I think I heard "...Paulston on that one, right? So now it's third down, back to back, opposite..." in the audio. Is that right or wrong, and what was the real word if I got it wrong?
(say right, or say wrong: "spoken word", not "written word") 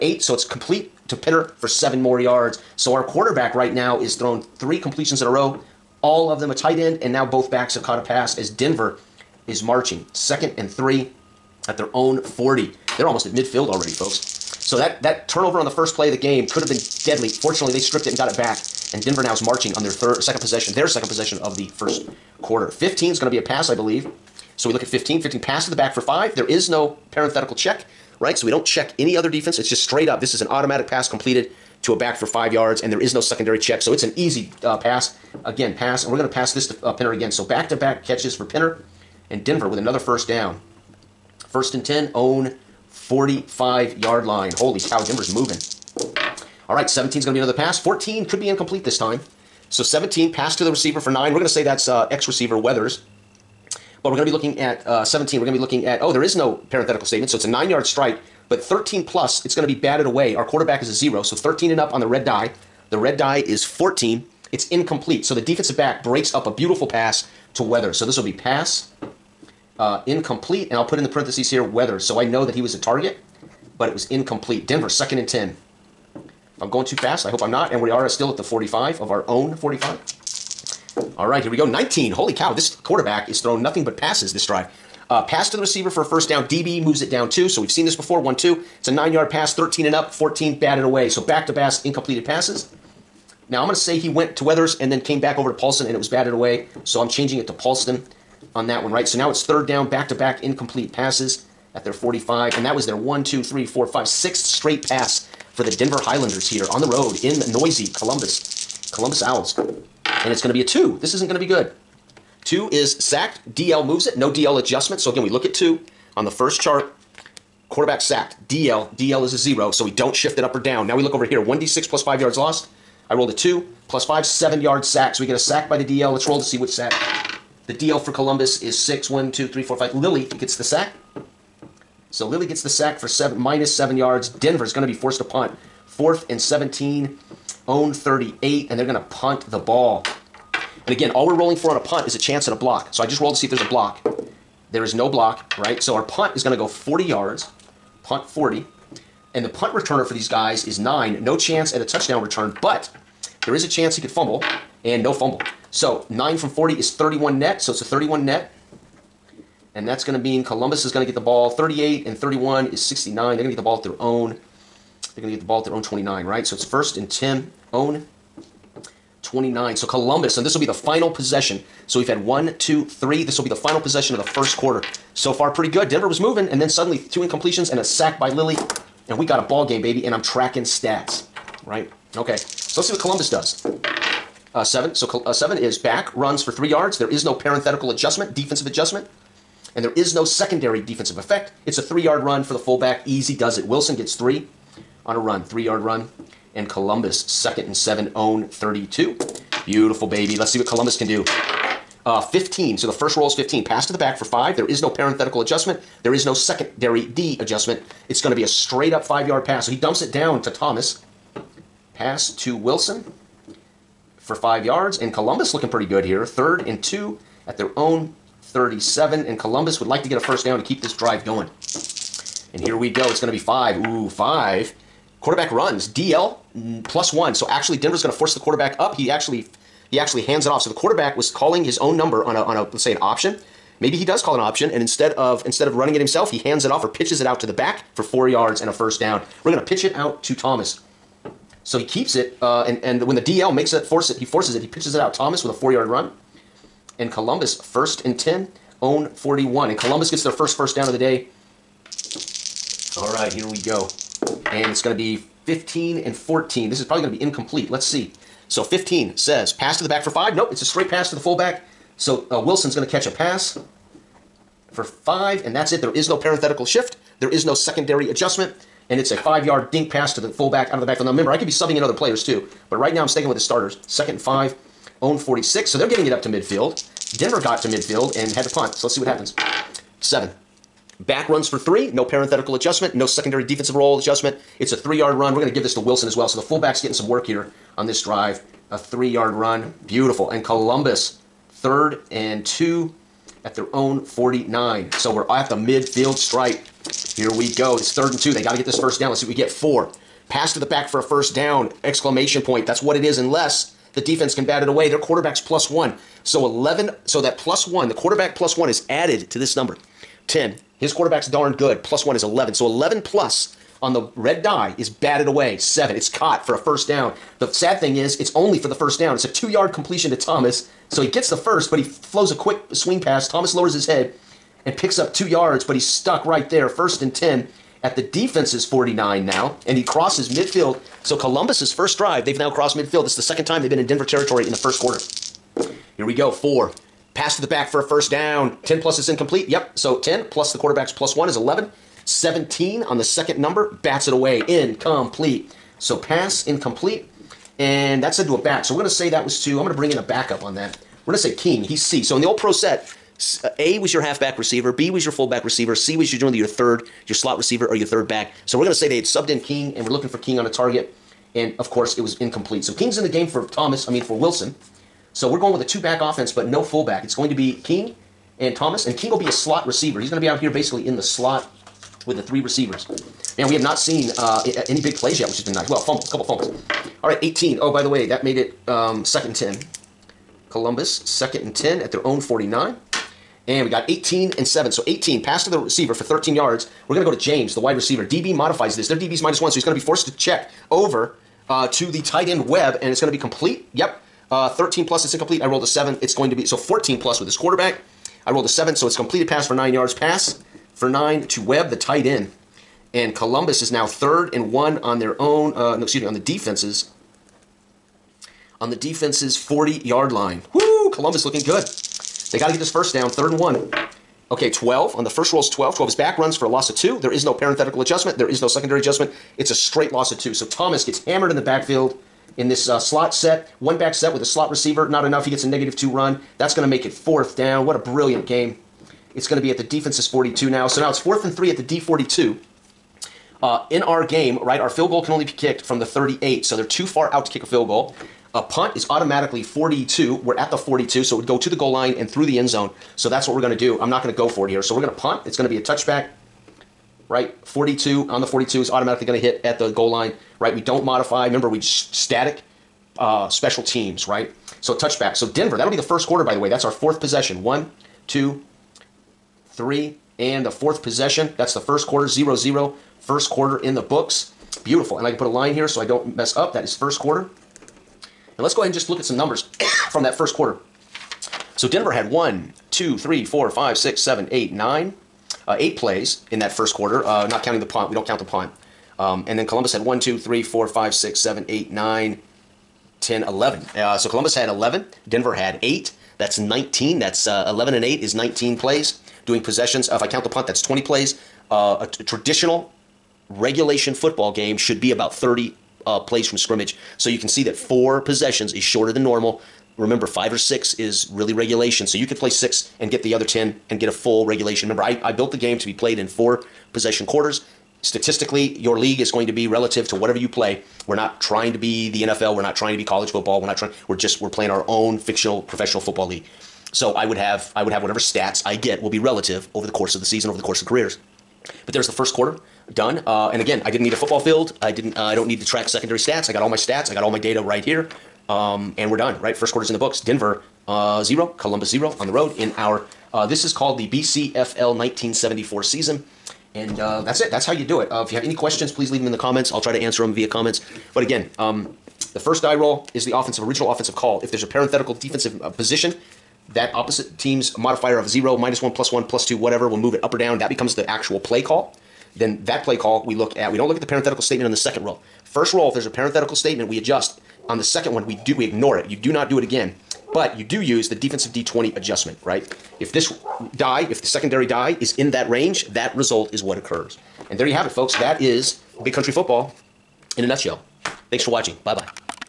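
wrong: "incomplete", not "opposite".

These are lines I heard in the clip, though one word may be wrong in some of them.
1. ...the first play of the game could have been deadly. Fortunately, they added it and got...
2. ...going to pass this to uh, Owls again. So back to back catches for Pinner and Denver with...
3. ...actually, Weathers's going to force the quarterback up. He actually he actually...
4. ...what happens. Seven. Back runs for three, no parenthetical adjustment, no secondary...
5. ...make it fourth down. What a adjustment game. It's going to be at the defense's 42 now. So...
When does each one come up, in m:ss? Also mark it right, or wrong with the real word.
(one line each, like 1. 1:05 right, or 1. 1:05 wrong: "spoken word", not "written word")
1. 0:15 wrong: "stripped", not "added"
2. 0:36 wrong: "Pinner", not "Owls"
3. 3:47 wrong: "Denver", not "Weathers"
4. 4:38 right
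5. 7:06 wrong: "brilliant", not "adjustment".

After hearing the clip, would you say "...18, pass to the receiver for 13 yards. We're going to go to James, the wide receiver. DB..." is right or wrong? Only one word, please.
right.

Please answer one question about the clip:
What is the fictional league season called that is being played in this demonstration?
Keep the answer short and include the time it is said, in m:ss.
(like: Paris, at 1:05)
BCFL 1974 season, at 8:53.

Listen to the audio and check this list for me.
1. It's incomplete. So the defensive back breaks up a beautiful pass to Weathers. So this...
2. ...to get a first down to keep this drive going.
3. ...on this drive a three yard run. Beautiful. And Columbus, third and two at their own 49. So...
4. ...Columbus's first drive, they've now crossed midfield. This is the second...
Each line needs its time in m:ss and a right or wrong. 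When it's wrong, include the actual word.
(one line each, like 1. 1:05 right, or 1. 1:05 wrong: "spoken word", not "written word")
1. 1:04 right
2. 3:40 right
3. 4:47 right
4. 5:31 right.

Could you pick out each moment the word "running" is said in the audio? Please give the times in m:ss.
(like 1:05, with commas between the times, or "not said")
3:55.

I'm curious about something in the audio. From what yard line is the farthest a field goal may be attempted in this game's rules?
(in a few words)
38.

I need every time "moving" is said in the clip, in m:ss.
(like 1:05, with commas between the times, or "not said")
0:45, 2:56.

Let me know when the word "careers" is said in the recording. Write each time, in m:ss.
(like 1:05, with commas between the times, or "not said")
8:40.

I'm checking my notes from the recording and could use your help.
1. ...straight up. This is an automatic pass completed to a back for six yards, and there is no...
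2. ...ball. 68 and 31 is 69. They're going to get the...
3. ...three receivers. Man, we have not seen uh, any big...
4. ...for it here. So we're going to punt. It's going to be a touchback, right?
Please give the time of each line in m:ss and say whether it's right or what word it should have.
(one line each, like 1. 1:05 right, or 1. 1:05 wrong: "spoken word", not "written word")
1. 0:29 wrong: "five", not "six"
2. 2:41 wrong: "38", not "68"
3. 6:12 right
4. 7:24 right.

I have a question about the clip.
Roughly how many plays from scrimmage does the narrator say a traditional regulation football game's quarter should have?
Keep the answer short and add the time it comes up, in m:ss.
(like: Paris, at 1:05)
30, at 8:14.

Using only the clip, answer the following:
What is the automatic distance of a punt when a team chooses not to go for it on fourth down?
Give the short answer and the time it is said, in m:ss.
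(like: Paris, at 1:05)
42, at 7:18.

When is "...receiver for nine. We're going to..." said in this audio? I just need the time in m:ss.
0:50.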